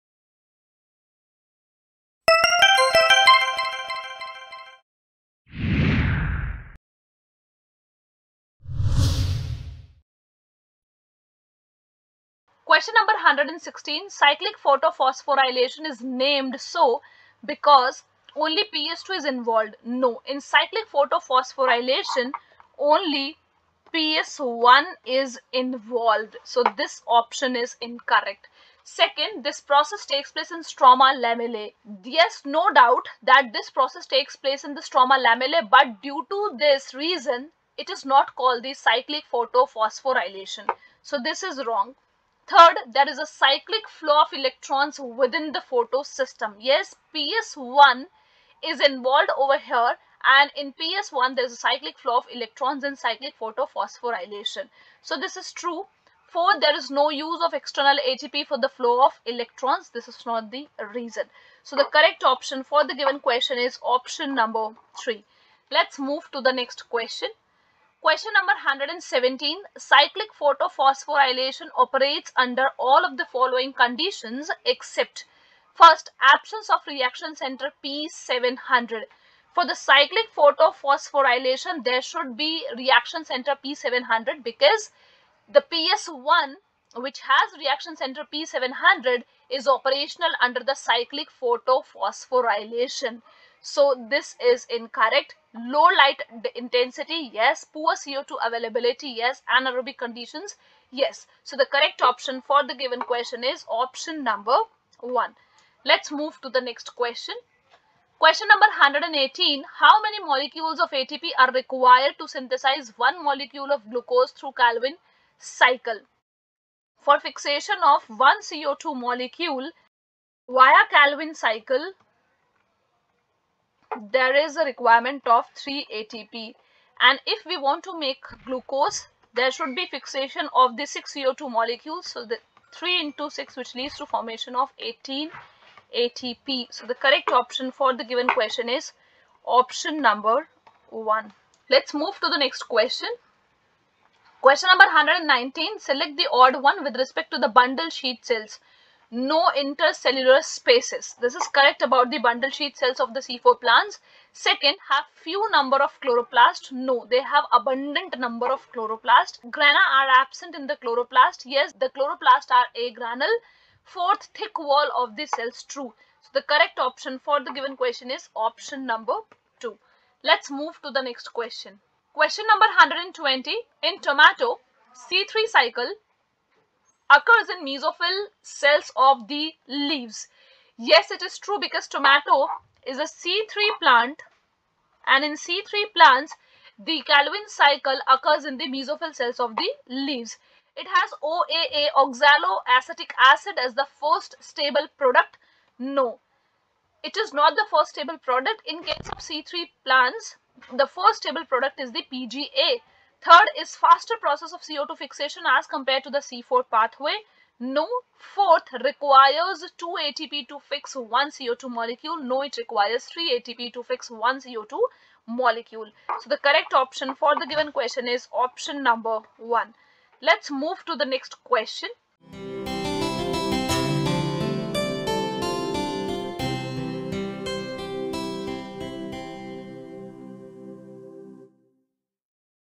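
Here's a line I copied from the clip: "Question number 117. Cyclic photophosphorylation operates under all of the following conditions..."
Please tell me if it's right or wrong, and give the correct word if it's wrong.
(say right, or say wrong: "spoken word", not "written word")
right.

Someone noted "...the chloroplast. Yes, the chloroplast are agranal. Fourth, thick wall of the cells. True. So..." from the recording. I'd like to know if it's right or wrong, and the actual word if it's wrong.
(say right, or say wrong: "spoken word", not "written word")
right.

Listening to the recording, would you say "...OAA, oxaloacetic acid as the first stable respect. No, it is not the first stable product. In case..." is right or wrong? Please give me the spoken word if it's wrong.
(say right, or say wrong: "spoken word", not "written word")
wrong: "product", not "respect".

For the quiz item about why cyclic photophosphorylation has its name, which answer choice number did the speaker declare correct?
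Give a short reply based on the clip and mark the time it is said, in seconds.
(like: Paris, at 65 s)
3, at 63 s.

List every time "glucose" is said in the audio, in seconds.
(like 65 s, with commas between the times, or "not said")
113 s, 128 s.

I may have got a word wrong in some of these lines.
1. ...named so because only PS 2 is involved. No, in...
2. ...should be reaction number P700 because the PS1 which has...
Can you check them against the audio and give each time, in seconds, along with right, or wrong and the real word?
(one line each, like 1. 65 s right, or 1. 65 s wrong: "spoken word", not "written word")
1. 16 s right
2. 82 s wrong: "center", not "number".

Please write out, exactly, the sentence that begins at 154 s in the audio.
Second, have few number of chloroplast.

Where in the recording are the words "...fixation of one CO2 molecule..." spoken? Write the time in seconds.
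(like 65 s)
117 s.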